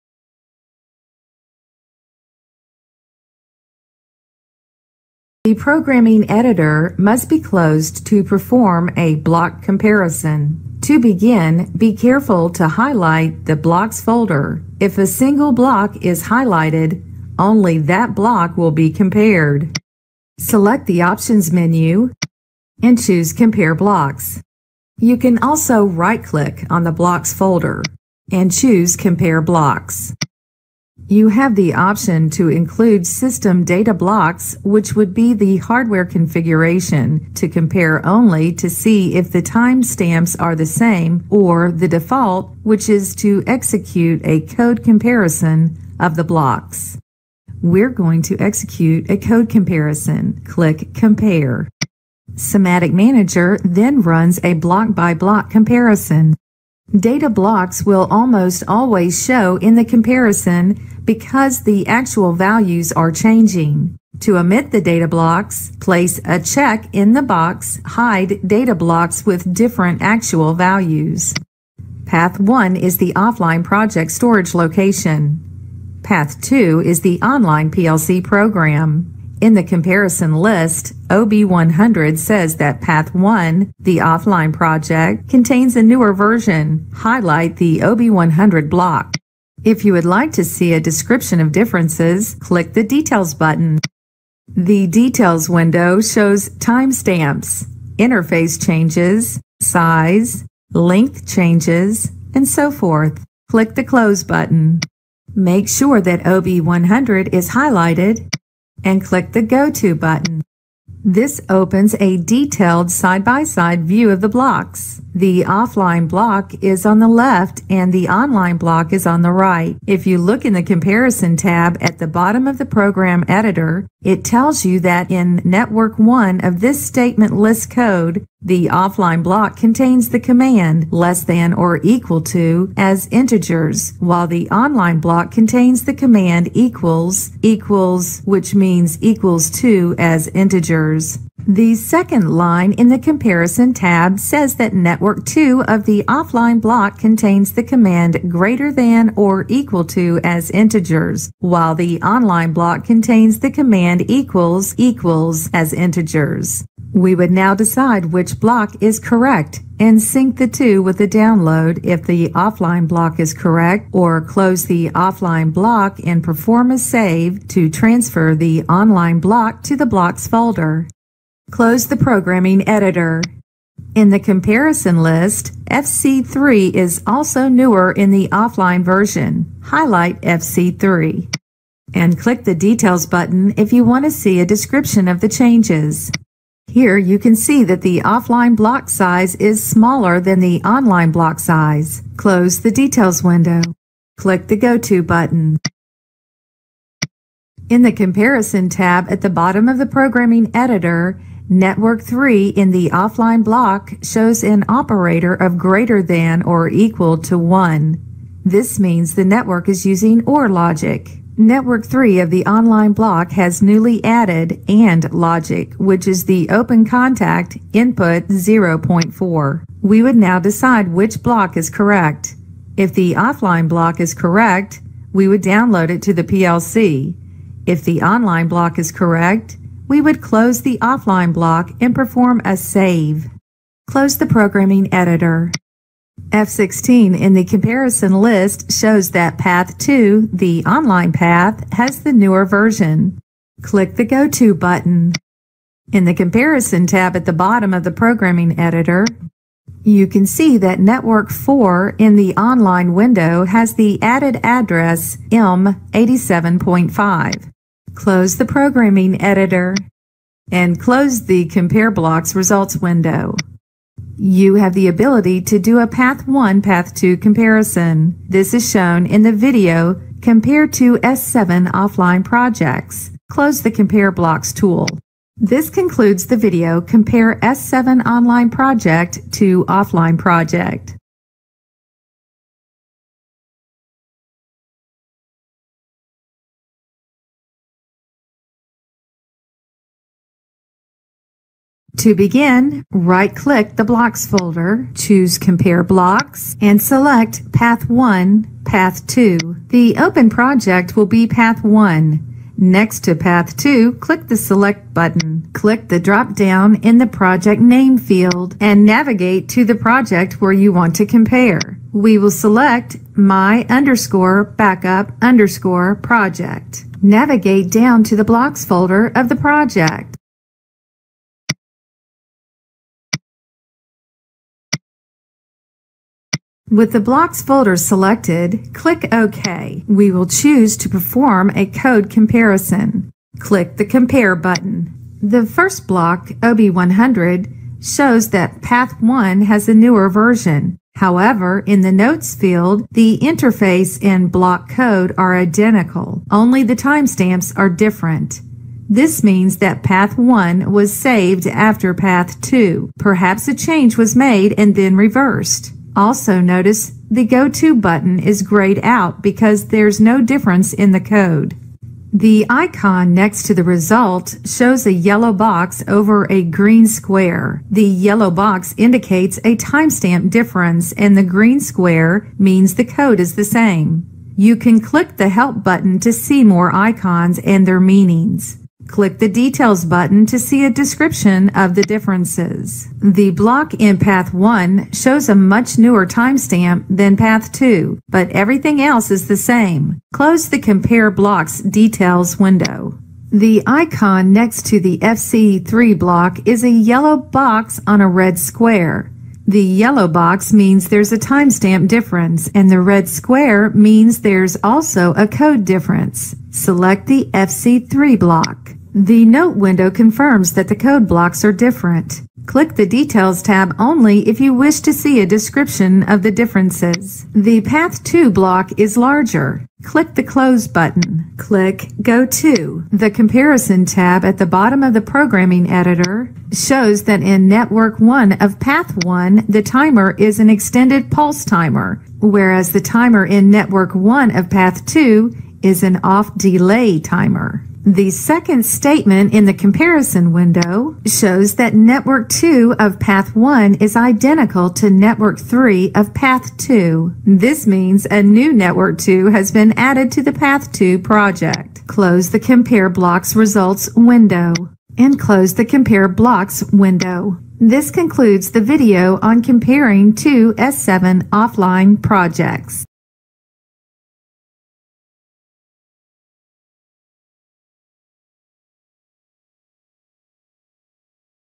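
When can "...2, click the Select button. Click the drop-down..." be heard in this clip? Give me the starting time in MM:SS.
05:03.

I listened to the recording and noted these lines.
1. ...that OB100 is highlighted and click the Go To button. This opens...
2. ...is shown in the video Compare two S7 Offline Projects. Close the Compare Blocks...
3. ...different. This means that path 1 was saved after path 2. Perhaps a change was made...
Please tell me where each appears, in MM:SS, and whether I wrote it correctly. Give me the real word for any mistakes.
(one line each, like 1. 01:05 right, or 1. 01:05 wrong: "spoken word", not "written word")
1. 01:46 right
2. 04:28 right
3. 05:47 right.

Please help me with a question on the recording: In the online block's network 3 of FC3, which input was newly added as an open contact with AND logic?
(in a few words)
input 0.4.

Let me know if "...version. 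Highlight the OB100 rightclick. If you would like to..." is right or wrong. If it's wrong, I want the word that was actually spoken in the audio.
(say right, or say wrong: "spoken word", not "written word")
wrong: "block", not "rightclick".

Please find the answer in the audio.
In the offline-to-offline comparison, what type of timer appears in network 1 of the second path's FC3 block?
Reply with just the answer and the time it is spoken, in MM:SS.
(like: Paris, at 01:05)
off-delay timer, at 07:16.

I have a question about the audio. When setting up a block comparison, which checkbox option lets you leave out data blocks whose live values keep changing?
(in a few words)
Hide data blocks with different actual values.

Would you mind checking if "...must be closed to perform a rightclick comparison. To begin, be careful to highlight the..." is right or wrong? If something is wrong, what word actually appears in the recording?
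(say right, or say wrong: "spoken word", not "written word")
wrong: "block", not "rightclick".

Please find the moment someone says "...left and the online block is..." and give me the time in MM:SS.
01:57.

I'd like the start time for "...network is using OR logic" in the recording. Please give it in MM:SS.
03:29.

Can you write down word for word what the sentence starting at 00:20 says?
Select the Options menu and choose Compare Blocks.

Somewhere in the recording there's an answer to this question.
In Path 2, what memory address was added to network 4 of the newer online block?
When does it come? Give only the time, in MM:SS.
04:15.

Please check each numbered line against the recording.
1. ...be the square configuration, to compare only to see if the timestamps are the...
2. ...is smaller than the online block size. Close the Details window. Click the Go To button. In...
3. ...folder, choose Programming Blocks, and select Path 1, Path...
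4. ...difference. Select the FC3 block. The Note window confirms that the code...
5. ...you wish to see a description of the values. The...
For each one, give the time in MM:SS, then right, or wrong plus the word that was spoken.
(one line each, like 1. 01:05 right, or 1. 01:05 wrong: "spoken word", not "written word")
1. 00:35 wrong: "hardware", not "square"
2. 03:09 right
3. 04:54 wrong: "Compare", not "Programming"
4. 06:45 right
5. 06:54 wrong: "differences", not "values".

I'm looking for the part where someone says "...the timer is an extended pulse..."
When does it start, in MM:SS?
07:09.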